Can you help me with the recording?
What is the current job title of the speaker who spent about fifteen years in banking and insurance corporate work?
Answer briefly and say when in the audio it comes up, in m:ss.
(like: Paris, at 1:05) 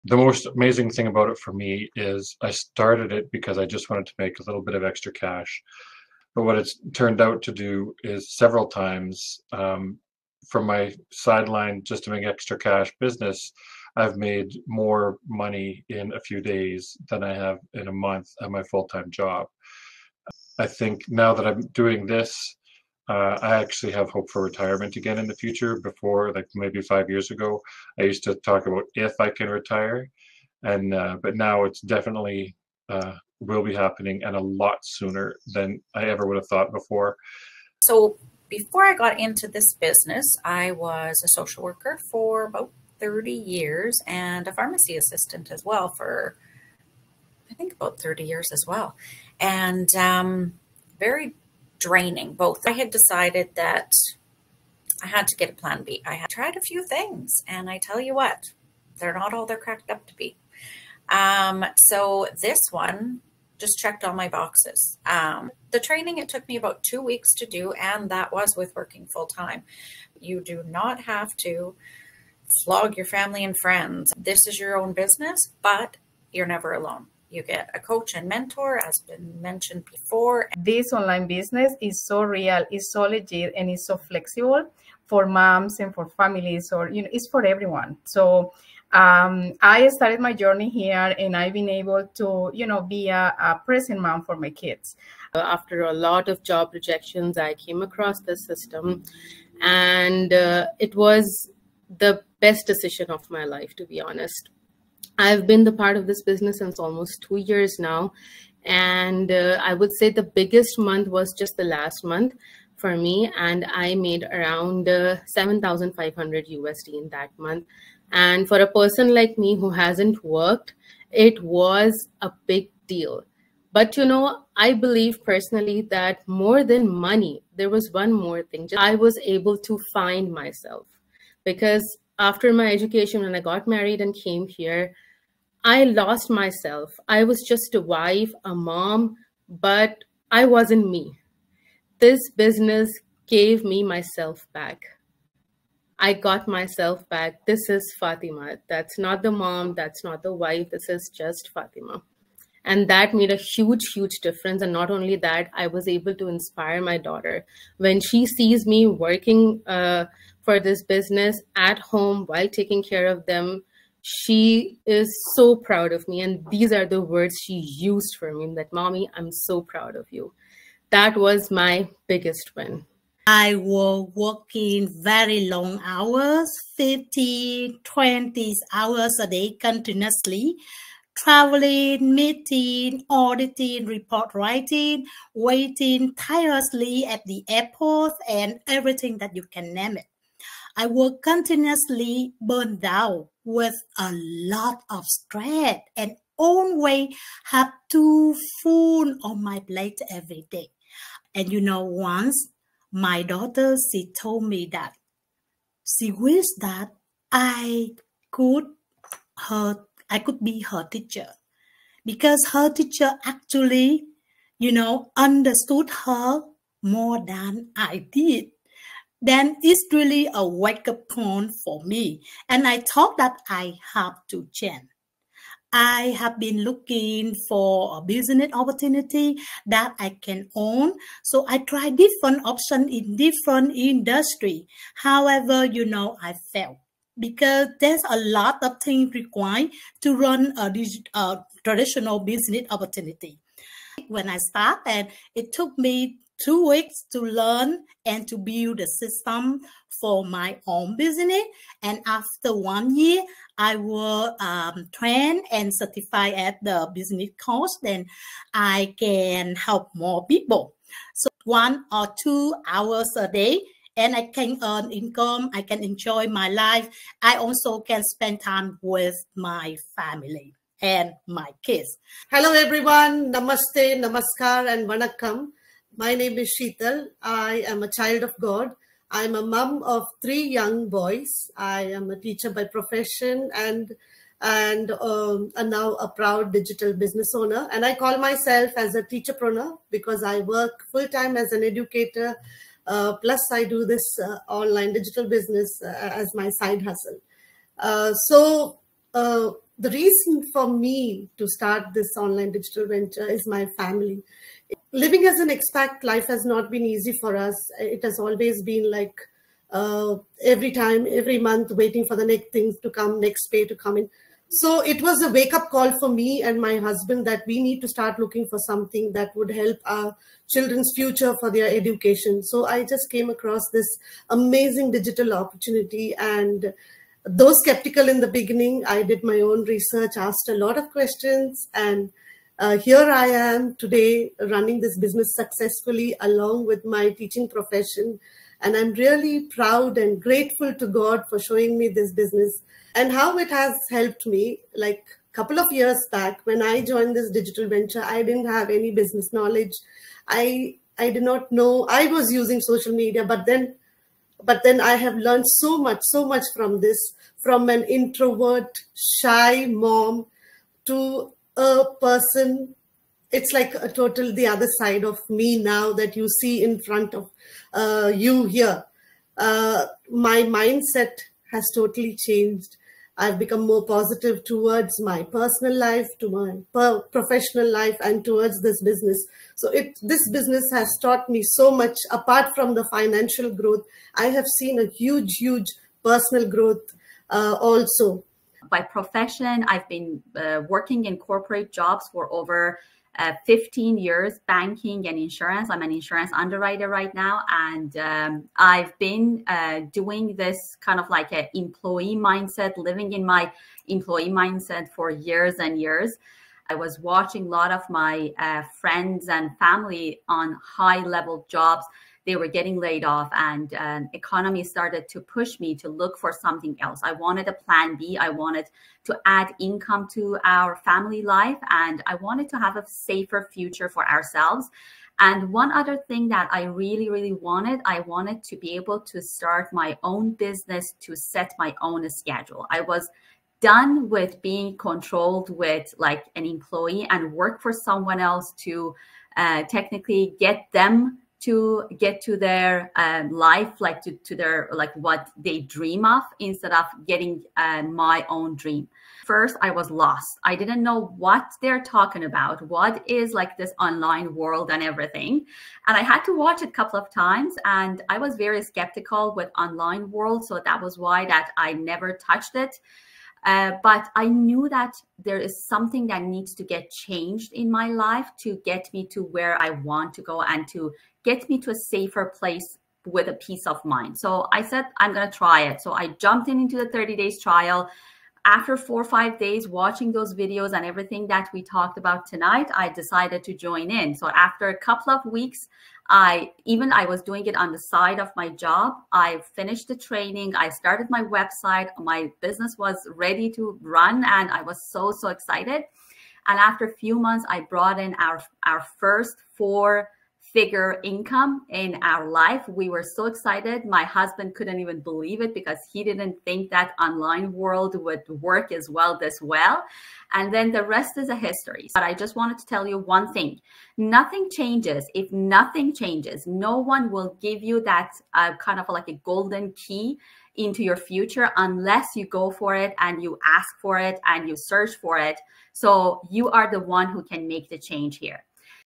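insurance underwriter, at 6:35.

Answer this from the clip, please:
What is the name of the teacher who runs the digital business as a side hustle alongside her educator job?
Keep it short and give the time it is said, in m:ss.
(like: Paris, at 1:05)
Sheetal, at 4:36.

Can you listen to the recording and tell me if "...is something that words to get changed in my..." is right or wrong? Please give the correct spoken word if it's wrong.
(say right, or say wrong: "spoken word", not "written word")
wrong: "needs", not "words".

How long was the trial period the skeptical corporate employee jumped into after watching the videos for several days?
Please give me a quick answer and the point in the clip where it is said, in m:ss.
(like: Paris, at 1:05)
30 days, at 7:56.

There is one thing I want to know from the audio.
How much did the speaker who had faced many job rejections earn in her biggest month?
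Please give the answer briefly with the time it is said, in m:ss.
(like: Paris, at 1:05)
7,500 USD, at 1:55.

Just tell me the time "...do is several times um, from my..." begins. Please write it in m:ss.
0:07.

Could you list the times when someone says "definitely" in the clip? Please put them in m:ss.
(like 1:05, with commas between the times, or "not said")
0:31.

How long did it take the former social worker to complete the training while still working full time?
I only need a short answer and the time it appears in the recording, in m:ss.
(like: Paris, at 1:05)
2 weeks, at 1:06.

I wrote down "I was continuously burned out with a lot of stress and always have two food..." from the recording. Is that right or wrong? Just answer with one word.
right.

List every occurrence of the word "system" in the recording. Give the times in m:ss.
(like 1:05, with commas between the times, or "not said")
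1:38, 4:08.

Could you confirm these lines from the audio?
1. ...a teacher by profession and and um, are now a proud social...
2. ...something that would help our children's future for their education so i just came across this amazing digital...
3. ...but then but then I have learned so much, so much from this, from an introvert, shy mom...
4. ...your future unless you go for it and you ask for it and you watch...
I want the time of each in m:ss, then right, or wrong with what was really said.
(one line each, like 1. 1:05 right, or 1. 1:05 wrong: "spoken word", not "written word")
1. 4:42 wrong: "digital", not "social"
2. 5:18 right
3. 5:53 right
4. 8:40 wrong: "search", not "watch".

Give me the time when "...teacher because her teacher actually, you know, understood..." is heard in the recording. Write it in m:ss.
3:30.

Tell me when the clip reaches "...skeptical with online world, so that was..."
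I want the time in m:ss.
7:38.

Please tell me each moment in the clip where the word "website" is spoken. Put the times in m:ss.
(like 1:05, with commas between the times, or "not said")
8:11.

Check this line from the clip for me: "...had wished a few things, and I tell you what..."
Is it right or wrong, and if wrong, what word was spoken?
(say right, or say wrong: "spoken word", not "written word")
wrong: "tried", not "wished".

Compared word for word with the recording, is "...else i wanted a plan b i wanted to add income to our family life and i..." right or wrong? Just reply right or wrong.
right.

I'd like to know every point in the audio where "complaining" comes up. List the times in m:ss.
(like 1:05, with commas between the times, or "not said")
not said.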